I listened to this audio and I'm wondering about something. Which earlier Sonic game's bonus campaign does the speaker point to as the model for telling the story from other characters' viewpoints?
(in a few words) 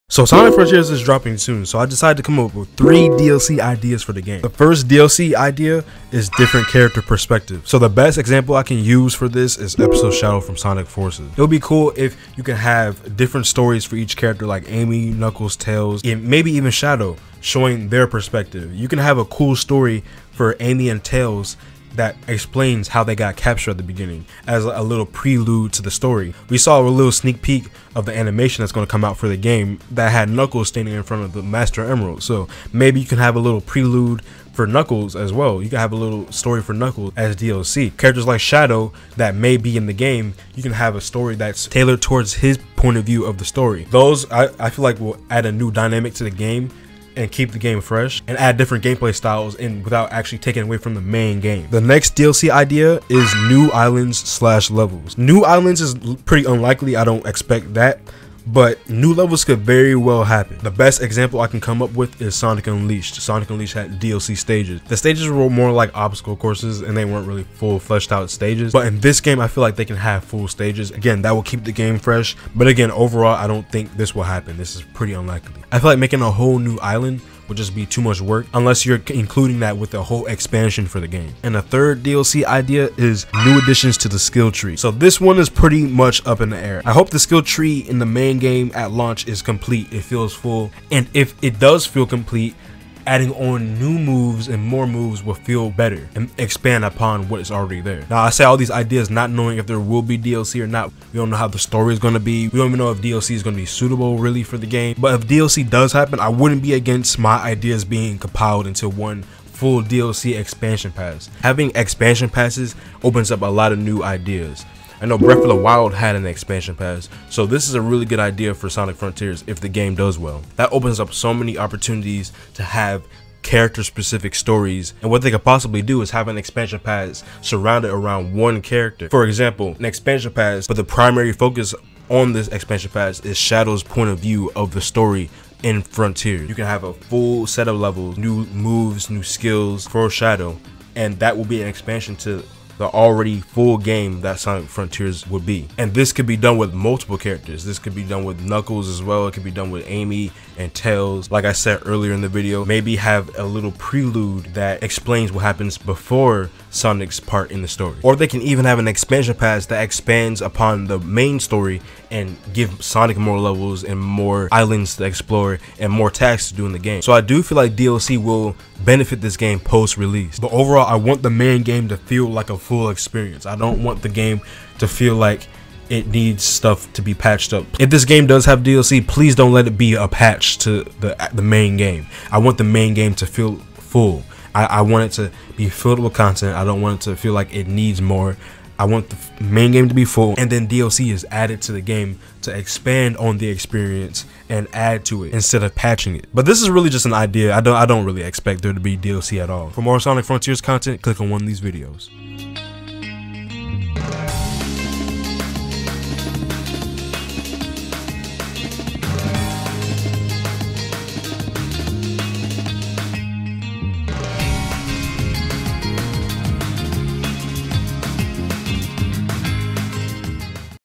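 Sonic Forces.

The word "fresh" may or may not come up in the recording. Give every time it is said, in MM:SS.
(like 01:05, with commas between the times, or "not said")
00:47, 01:11.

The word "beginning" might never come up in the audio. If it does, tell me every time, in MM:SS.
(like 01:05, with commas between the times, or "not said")
00:23.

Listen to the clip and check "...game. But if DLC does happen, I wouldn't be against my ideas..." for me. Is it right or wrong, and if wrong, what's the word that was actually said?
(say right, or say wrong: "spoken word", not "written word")
right.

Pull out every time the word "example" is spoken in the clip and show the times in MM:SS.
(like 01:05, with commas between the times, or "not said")
00:08, 01:01, 02:09.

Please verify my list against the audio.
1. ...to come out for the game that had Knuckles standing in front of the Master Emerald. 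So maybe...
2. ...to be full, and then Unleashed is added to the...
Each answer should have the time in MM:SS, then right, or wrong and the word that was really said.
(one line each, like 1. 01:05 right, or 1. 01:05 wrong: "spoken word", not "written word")
1. 00:28 right
2. 03:09 wrong: "DLC", not "Unleashed".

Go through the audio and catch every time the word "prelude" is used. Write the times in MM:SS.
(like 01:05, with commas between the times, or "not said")
00:25, 00:33, 02:33.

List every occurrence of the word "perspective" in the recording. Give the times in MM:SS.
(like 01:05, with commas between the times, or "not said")
00:07, 00:18.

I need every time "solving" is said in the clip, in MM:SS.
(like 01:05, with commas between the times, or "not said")
not said.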